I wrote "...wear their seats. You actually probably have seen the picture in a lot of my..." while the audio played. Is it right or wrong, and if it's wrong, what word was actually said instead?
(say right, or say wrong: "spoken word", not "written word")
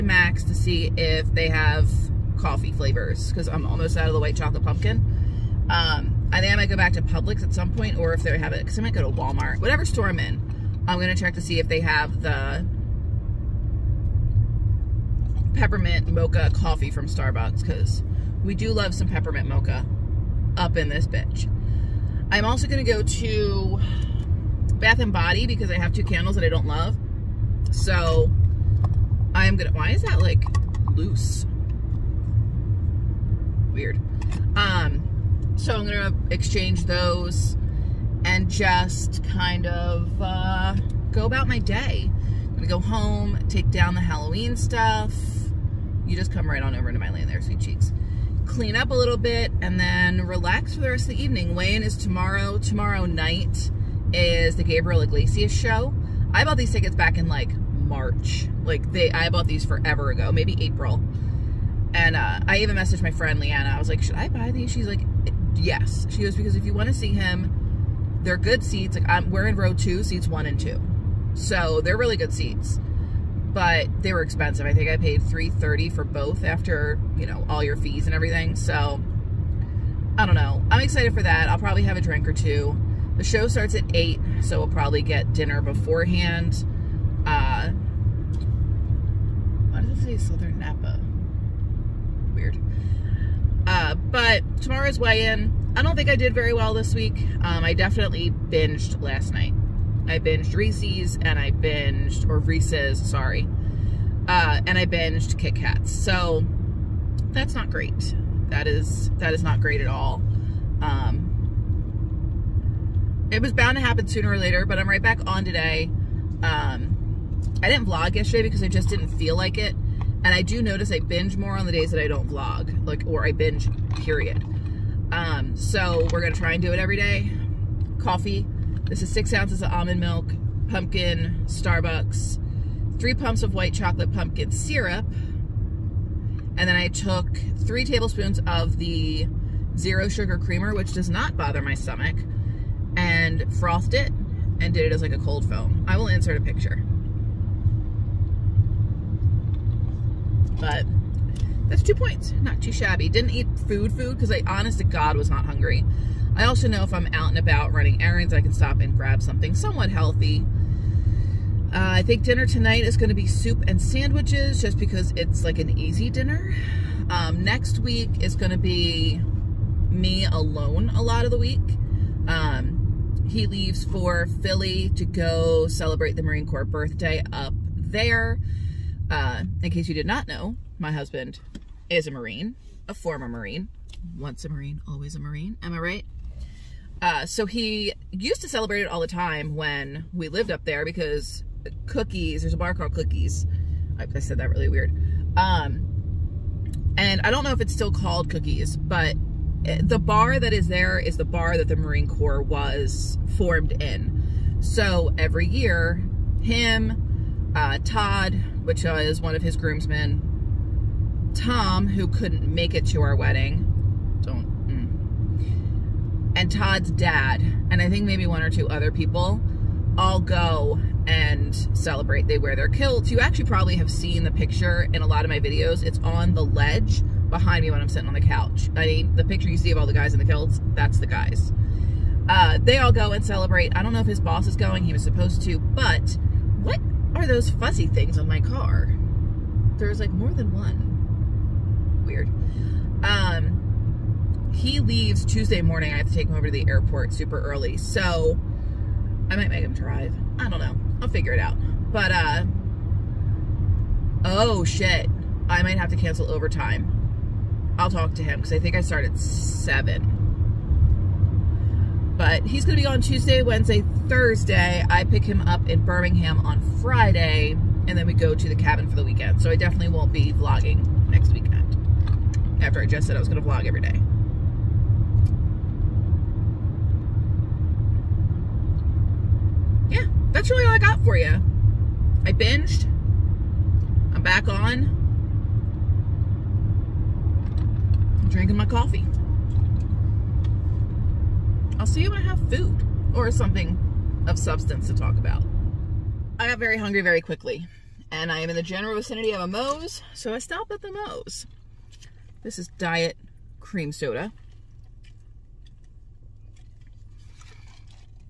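wrong: "kilts", not "seats".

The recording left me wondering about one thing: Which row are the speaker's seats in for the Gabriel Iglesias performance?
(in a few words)
Row 2.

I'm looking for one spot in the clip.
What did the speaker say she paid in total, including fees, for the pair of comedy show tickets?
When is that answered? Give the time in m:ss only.
1:15.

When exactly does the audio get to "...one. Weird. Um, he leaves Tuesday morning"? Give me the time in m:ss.
4:00.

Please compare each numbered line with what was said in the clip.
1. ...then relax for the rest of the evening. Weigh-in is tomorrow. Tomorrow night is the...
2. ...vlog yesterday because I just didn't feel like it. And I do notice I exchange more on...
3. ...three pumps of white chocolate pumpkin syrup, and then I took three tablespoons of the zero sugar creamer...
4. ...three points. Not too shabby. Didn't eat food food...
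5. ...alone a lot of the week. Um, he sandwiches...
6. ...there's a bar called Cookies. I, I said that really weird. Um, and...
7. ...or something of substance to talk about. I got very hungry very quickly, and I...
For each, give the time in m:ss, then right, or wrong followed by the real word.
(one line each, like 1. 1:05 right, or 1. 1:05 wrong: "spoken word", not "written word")
1. 0:49 right
2. 1:57 wrong: "binge", not "exchange"
3. 2:12 right
4. 2:31 wrong: "two", not "three"
5. 2:50 wrong: "leaves", not "sandwiches"
6. 3:12 right
7. 4:53 right.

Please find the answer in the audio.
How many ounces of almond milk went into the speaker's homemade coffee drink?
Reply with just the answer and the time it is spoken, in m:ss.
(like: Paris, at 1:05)
6, at 2:09.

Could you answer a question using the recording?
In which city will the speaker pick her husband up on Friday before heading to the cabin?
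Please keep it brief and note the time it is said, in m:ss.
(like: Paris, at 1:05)
Birmingham, at 4:25.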